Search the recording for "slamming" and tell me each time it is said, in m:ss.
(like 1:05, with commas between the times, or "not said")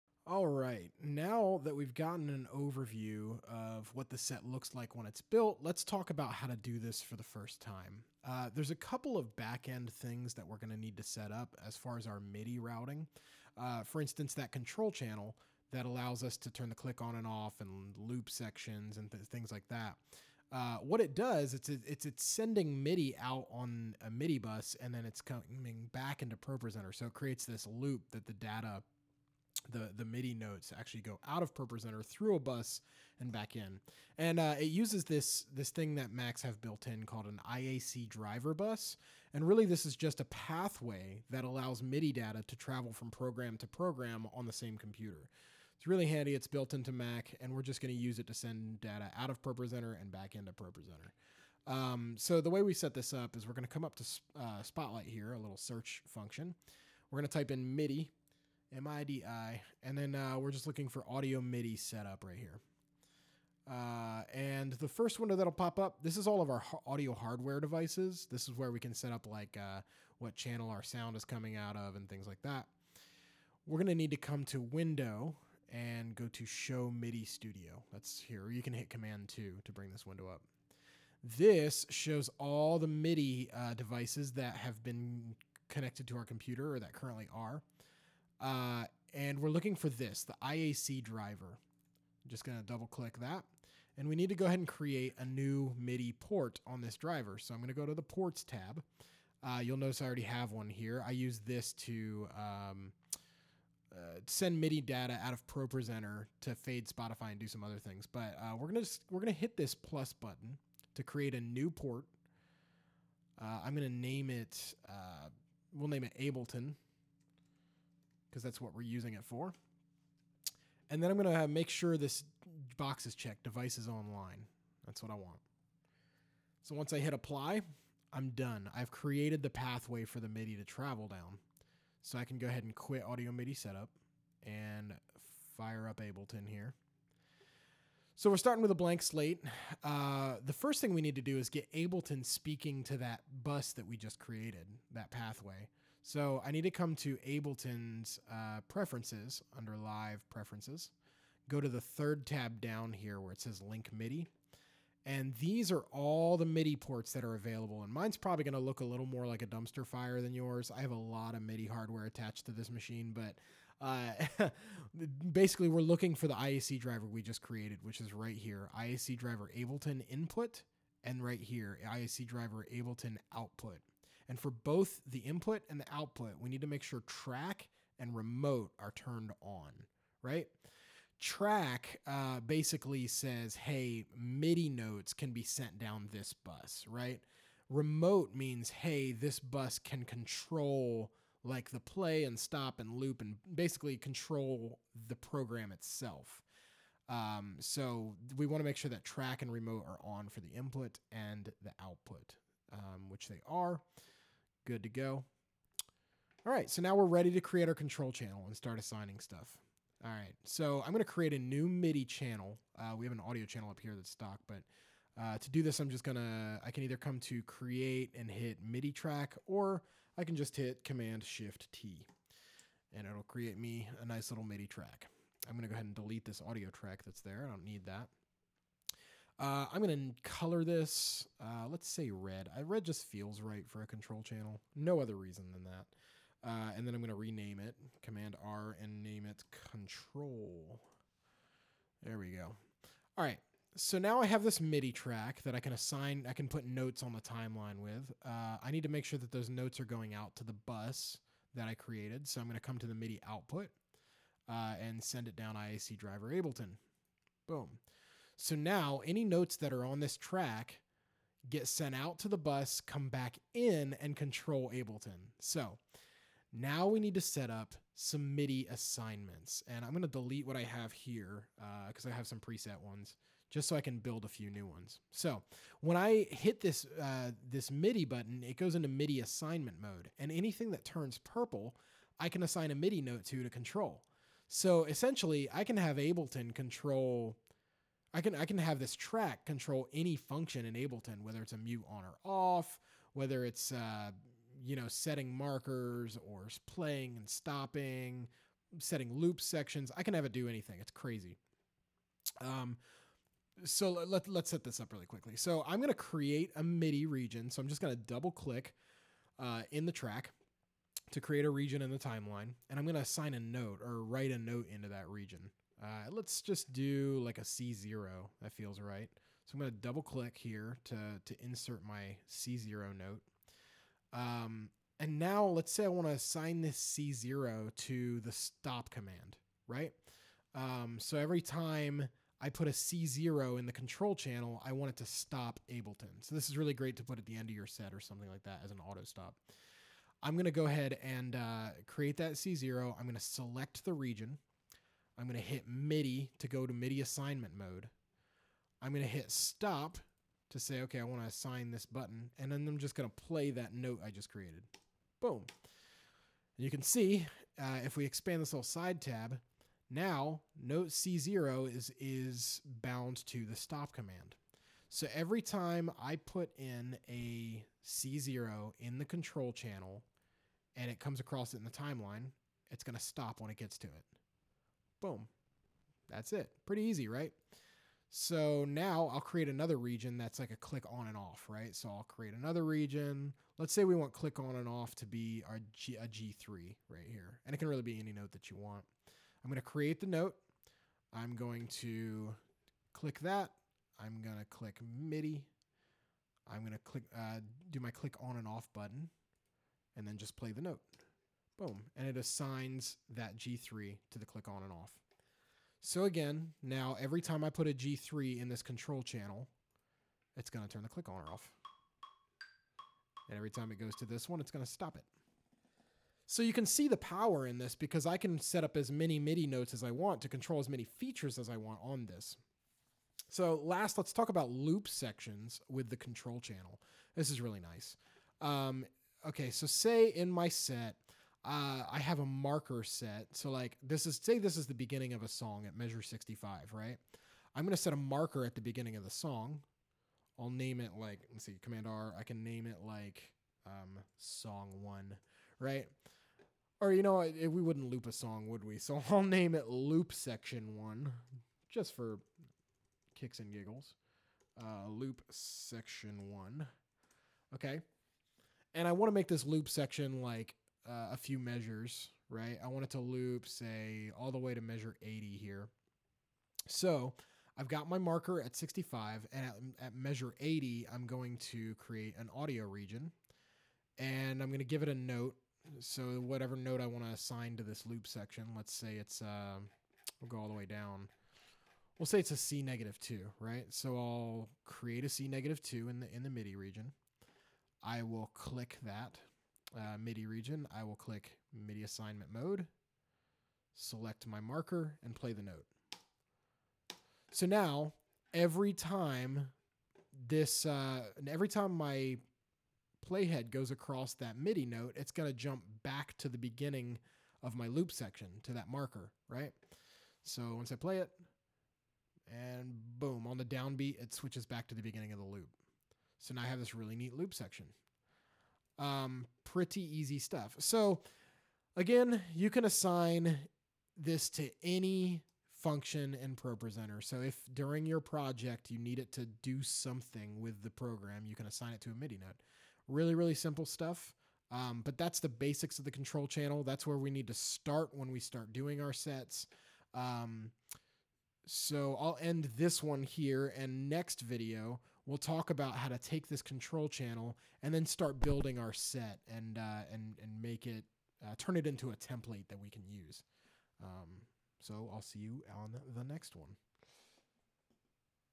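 not said.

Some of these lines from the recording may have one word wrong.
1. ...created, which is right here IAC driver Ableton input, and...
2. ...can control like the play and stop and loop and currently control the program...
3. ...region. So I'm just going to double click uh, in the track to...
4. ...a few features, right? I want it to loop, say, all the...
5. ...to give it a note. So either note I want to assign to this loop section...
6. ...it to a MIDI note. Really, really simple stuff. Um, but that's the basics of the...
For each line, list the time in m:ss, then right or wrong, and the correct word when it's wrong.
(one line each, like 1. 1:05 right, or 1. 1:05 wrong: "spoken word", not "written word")
1. 2:47 right
2. 3:09 wrong: "basically", not "currently"
3. 5:07 right
4. 7:41 wrong: "measures", not "features"
5. 7:54 wrong: "whatever", not "either"
6. 8:51 right.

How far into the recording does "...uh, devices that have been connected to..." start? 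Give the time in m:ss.
1:23.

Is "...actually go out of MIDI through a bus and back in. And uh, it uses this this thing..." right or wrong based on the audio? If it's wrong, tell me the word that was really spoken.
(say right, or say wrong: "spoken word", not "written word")
wrong: "ProPresenter", not "MIDI".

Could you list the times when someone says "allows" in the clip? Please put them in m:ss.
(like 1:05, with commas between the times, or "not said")
0:15, 0:41.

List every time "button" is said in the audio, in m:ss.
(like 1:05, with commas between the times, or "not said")
1:50, 4:38, 5:51, 6:38.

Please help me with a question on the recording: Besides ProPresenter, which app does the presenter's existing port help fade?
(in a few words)
Spotify.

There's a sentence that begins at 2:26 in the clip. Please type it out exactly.
So I need to come to Ableton's uh, preferences under live preferences.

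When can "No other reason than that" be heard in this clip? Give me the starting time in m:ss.
3:54.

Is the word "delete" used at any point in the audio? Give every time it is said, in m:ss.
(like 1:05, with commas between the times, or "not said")
3:45, 4:30.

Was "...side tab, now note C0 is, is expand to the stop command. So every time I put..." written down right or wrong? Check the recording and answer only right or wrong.
wrong.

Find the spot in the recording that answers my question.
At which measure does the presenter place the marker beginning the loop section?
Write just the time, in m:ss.
7:15.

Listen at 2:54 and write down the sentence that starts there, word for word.
And for both the input and the output, we need to make sure track and remote are turned on, right?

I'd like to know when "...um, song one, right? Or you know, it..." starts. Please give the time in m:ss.
7:23.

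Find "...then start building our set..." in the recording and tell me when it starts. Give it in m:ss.
9:07.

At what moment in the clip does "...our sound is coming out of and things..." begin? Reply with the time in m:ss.
1:10.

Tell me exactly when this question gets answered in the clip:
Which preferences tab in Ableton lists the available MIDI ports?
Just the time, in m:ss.
2:33.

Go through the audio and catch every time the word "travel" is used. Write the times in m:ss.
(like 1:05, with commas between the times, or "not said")
0:42, 2:10.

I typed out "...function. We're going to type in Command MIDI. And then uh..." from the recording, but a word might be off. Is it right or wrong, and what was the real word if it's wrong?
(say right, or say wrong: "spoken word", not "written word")
wrong: "MIDI", not "Command".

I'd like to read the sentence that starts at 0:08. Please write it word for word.
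Uh, there's a couple of back end things that we're going to need to set up as far as our MIDI routing.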